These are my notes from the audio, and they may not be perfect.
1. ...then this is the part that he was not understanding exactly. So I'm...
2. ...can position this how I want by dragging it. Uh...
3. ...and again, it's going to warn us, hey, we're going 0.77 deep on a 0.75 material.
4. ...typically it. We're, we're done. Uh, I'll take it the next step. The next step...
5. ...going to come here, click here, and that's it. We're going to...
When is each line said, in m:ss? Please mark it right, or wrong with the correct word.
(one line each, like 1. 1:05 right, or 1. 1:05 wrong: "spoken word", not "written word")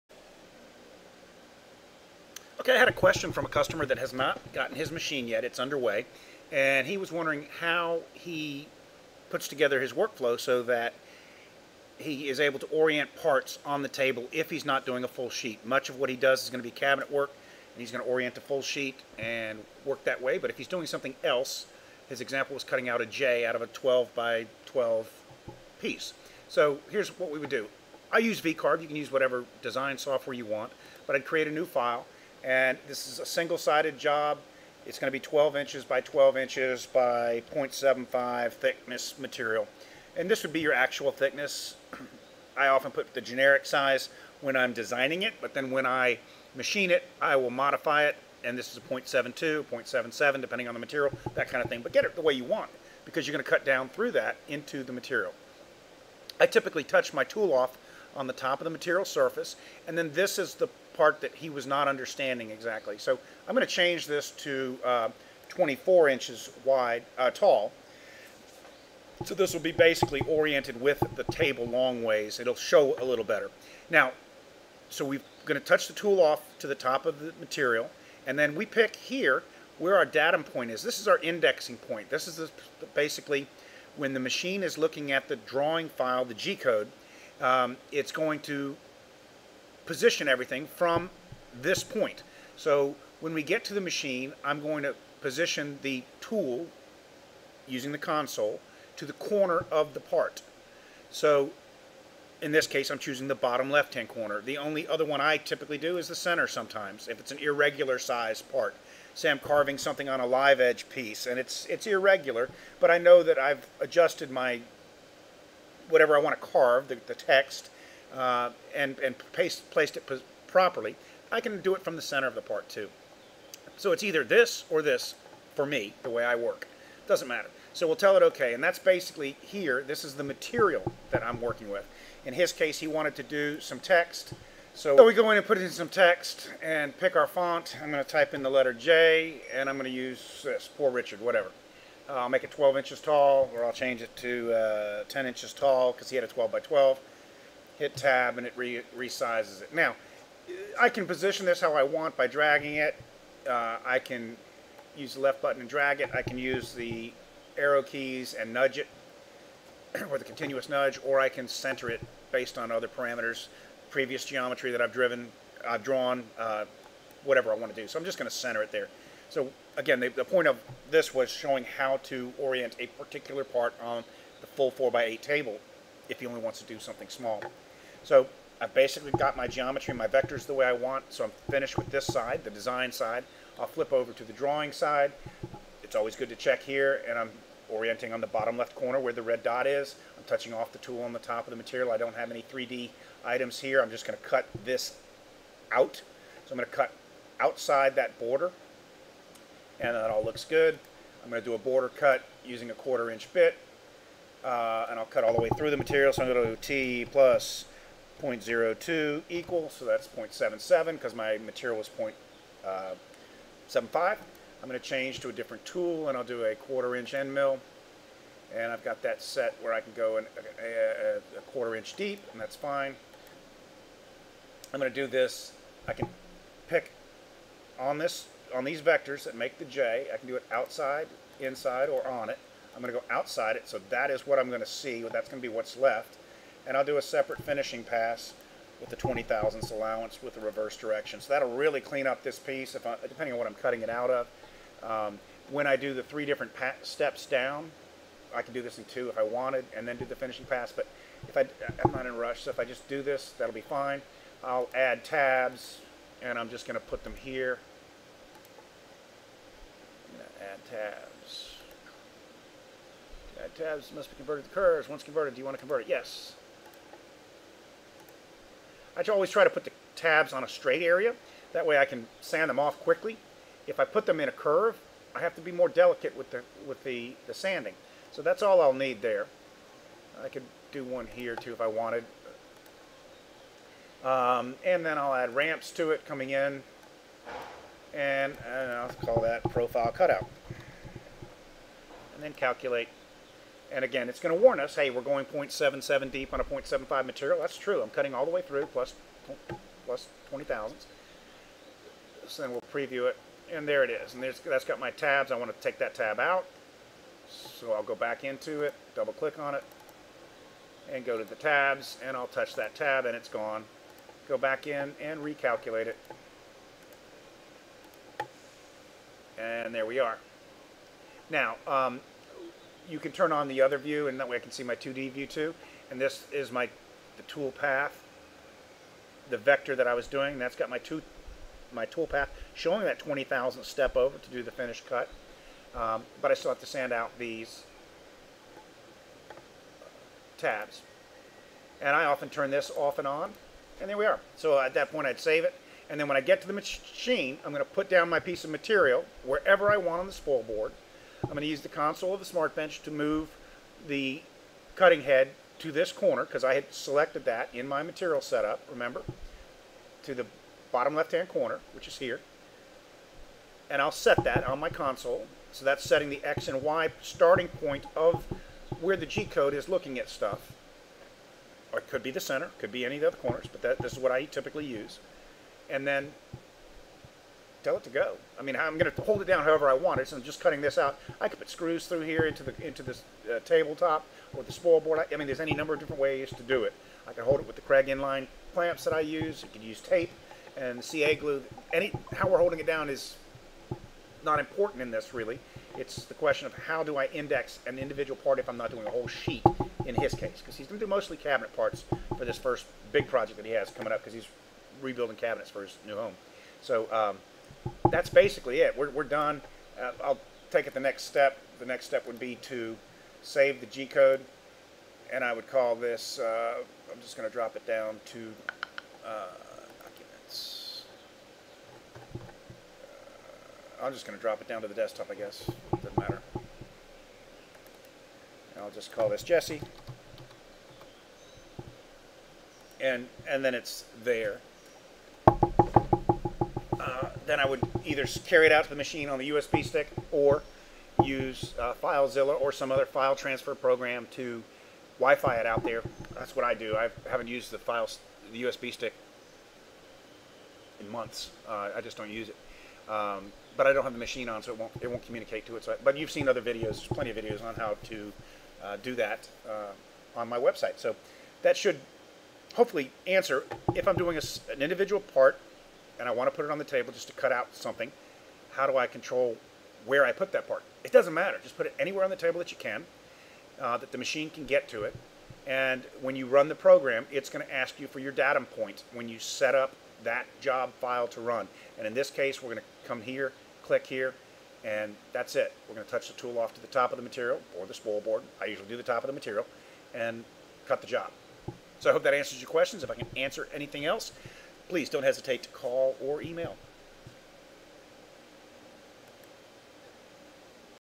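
1. 0:59 right
2. 2:30 right
3. 4:53 right
4. 6:48 wrong: "basically", not "typically"
5. 8:02 right.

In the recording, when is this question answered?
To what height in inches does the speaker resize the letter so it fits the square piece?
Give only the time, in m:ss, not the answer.
2:25.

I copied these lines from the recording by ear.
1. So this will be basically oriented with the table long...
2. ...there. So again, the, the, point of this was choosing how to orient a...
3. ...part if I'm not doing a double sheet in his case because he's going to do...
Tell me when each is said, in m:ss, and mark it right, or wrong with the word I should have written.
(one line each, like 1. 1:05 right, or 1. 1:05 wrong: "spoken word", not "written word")
1. 1:09 right
2. 2:48 wrong: "showing", not "choosing"
3. 6:38 wrong: "whole", not "double".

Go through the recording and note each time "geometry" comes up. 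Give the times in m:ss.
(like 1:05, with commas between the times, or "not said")
2:44, 2:59.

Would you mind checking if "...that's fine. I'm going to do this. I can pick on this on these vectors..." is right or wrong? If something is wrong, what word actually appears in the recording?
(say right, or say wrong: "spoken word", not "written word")
right.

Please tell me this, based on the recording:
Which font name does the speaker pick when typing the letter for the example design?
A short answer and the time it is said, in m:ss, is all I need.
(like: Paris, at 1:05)
Poor Richard, at 2:20.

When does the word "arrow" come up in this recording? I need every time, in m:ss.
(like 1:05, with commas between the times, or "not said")
2:37.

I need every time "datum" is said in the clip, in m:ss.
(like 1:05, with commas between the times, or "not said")
1:20, 7:58.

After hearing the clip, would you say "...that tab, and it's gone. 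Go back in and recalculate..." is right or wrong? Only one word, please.
right.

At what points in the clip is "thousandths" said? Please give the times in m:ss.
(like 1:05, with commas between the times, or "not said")
3:59, 5:00.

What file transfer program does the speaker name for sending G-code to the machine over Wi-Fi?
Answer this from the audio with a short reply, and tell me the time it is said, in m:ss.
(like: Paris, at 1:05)
FileZilla, at 7:21.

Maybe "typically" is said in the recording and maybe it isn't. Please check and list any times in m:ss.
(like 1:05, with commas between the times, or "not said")
0:56, 1:45, 6:14.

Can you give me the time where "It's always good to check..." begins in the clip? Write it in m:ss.
3:05.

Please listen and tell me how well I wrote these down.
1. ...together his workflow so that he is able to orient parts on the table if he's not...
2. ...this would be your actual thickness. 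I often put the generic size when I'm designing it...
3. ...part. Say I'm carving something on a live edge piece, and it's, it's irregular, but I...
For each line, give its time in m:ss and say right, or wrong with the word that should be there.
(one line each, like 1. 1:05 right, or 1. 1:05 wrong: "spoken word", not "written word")
1. 0:09 right
2. 0:40 right
3. 1:48 right.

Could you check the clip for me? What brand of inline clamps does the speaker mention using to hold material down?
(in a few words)
Kreg.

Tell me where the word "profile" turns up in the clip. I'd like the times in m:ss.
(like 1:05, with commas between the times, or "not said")
4:49.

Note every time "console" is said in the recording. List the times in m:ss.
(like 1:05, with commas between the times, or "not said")
1:37, 5:51, 6:04.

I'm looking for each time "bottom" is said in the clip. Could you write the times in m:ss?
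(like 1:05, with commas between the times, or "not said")
1:43, 3:08, 6:00.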